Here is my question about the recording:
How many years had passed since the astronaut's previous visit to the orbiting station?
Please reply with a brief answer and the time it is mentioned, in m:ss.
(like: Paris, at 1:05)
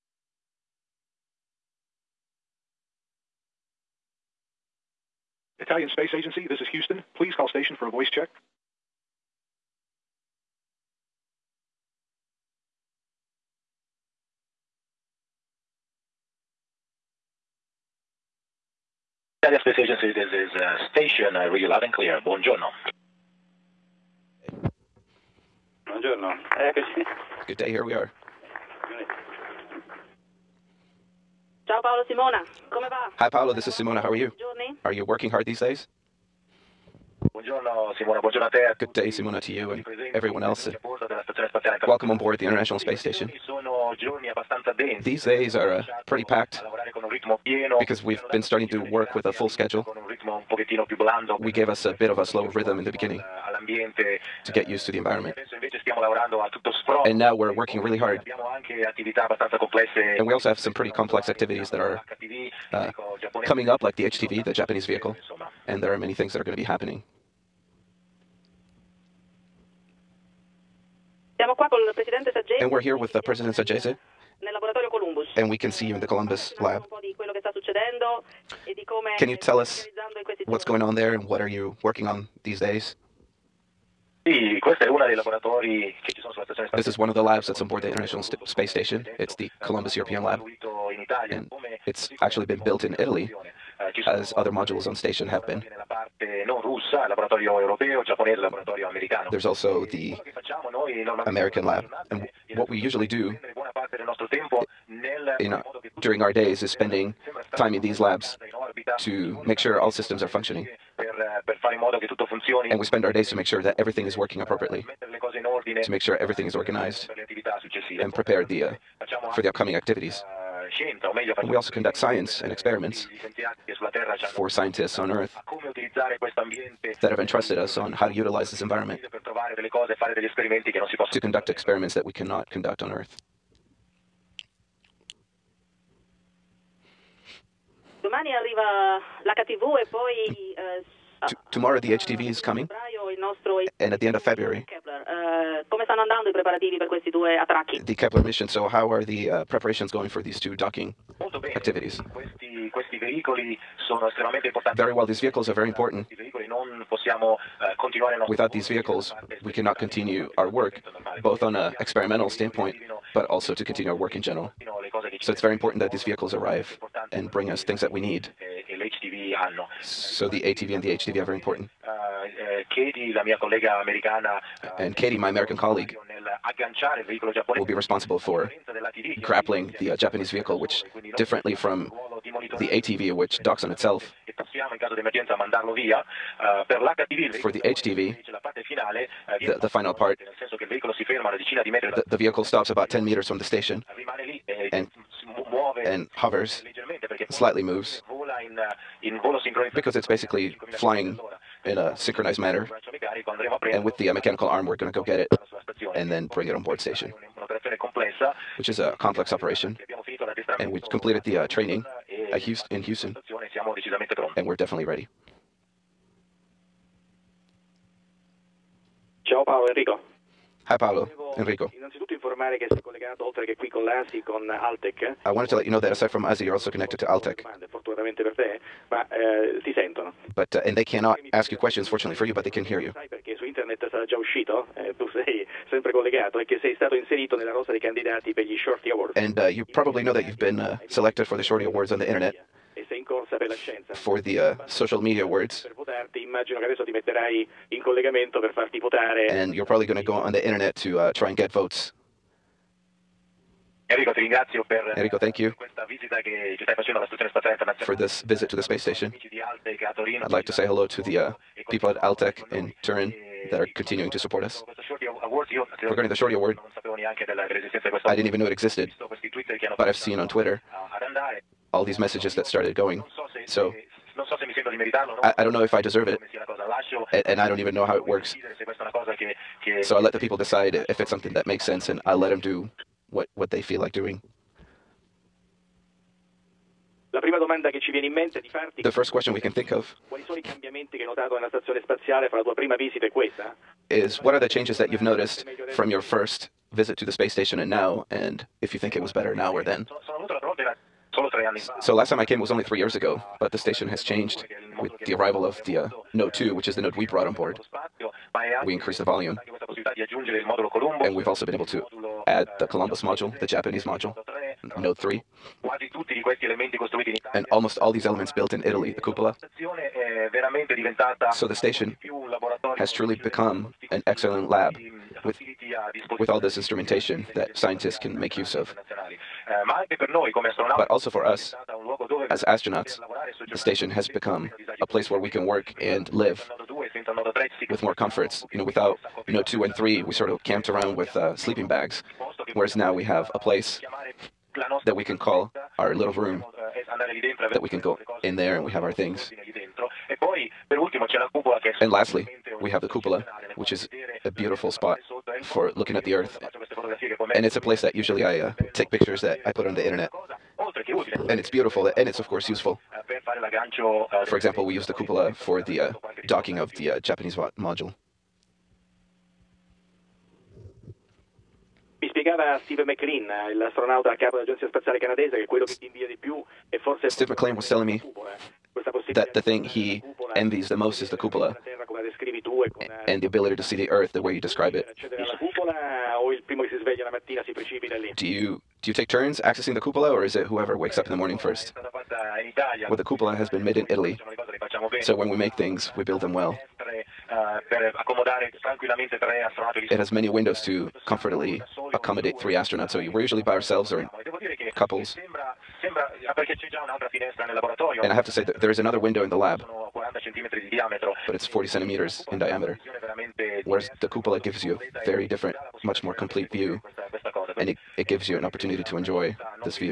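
3, at 5:02.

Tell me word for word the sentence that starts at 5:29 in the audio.
Eh, but also for us, as astronauts, the station has become a place where we can work and live with more comforts.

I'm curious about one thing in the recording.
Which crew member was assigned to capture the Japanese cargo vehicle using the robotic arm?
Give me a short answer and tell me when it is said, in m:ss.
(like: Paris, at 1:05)
Katie, at 2:54.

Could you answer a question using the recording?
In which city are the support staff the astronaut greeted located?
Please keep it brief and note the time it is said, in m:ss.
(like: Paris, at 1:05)
Turin, at 4:22.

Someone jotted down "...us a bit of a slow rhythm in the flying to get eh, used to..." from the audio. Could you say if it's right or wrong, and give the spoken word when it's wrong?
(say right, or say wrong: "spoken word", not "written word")
wrong: "beginning", not "flying".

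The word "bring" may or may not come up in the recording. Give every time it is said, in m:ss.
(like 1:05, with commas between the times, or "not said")
2:47, 3:26.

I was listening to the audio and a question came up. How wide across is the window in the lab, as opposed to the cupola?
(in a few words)
40 centimeters.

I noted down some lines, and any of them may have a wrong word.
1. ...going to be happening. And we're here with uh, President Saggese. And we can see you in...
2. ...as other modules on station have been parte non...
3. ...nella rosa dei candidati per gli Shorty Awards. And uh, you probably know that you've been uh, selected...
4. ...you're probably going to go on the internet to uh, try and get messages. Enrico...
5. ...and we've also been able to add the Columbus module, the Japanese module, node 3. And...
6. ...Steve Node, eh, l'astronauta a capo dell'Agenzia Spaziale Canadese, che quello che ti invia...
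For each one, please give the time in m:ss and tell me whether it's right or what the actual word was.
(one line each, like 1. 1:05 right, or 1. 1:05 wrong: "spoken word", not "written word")
1. 1:06 right
2. 1:34 right
3. 3:57 right
4. 4:09 wrong: "votes", not "messages"
5. 5:11 right
6. 6:12 wrong: "MacLean", not "Node".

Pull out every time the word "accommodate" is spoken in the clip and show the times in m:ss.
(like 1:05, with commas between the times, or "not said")
6:41.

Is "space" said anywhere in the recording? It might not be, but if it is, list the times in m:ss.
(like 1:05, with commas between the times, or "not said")
0:05, 0:19, 0:42, 1:28, 4:18, 4:57.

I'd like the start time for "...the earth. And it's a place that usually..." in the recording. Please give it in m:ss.
5:56.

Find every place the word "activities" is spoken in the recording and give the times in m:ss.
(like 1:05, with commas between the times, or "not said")
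1:01, 1:59, 2:31.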